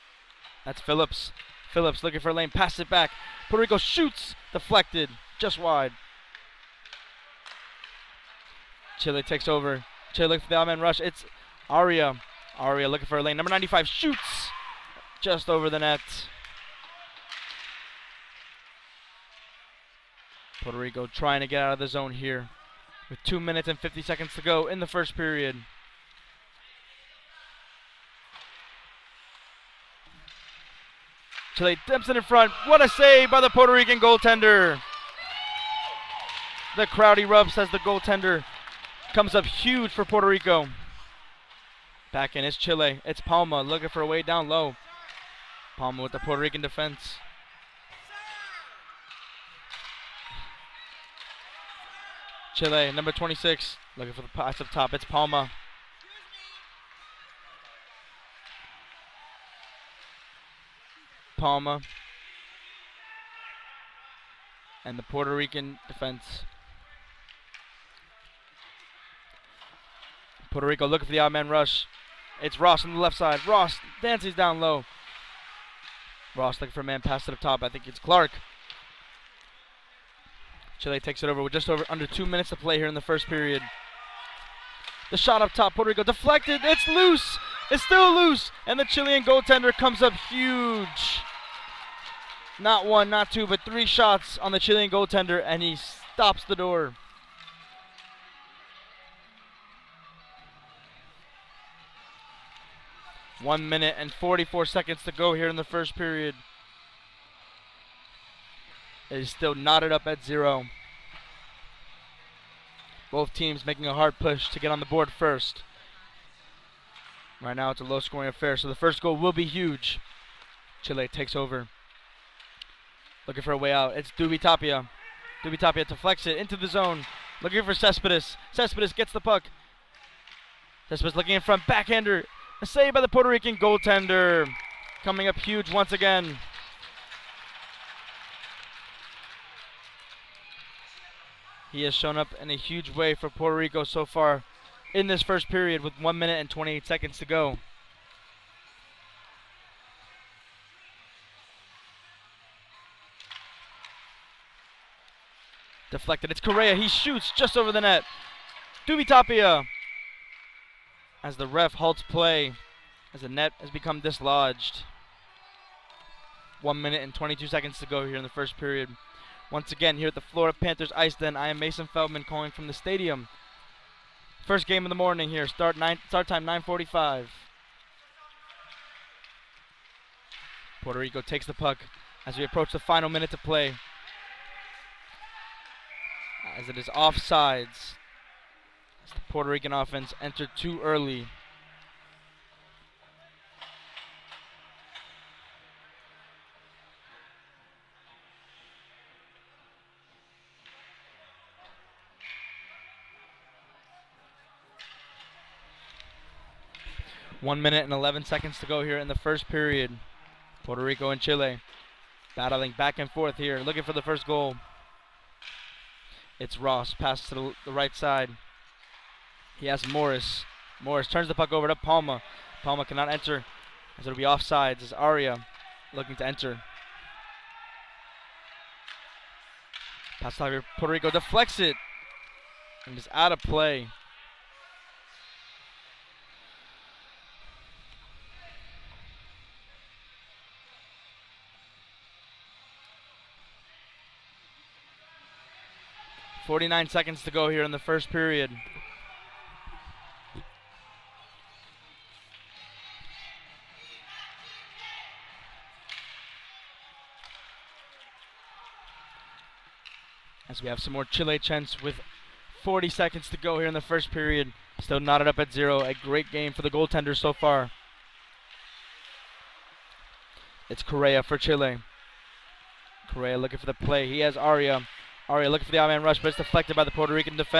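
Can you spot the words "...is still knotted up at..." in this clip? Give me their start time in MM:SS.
01:49.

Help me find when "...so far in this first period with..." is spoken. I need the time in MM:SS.
02:23.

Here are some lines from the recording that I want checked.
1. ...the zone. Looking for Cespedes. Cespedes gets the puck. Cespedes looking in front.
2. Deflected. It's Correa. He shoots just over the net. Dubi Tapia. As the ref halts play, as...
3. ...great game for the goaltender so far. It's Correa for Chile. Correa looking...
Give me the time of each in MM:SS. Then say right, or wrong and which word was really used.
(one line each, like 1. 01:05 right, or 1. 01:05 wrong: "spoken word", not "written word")
1. 02:06 right
2. 02:35 right
3. 04:25 right.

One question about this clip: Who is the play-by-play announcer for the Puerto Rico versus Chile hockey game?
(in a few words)
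Mason Feldman.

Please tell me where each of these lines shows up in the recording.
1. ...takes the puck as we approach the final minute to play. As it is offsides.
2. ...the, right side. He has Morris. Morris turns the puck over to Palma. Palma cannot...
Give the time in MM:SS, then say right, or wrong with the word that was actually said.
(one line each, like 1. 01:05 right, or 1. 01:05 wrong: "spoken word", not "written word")
1. 03:01 right
2. 03:37 right.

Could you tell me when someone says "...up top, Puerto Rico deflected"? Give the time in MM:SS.
01:25.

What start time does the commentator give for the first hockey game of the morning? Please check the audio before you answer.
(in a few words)
9:45.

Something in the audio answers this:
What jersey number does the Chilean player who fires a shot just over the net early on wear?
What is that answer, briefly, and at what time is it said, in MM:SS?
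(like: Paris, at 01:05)
95, at 00:13.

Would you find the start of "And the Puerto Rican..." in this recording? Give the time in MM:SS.
01:04.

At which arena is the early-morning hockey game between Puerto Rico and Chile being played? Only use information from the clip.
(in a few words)
Florida Panthers Ice Den.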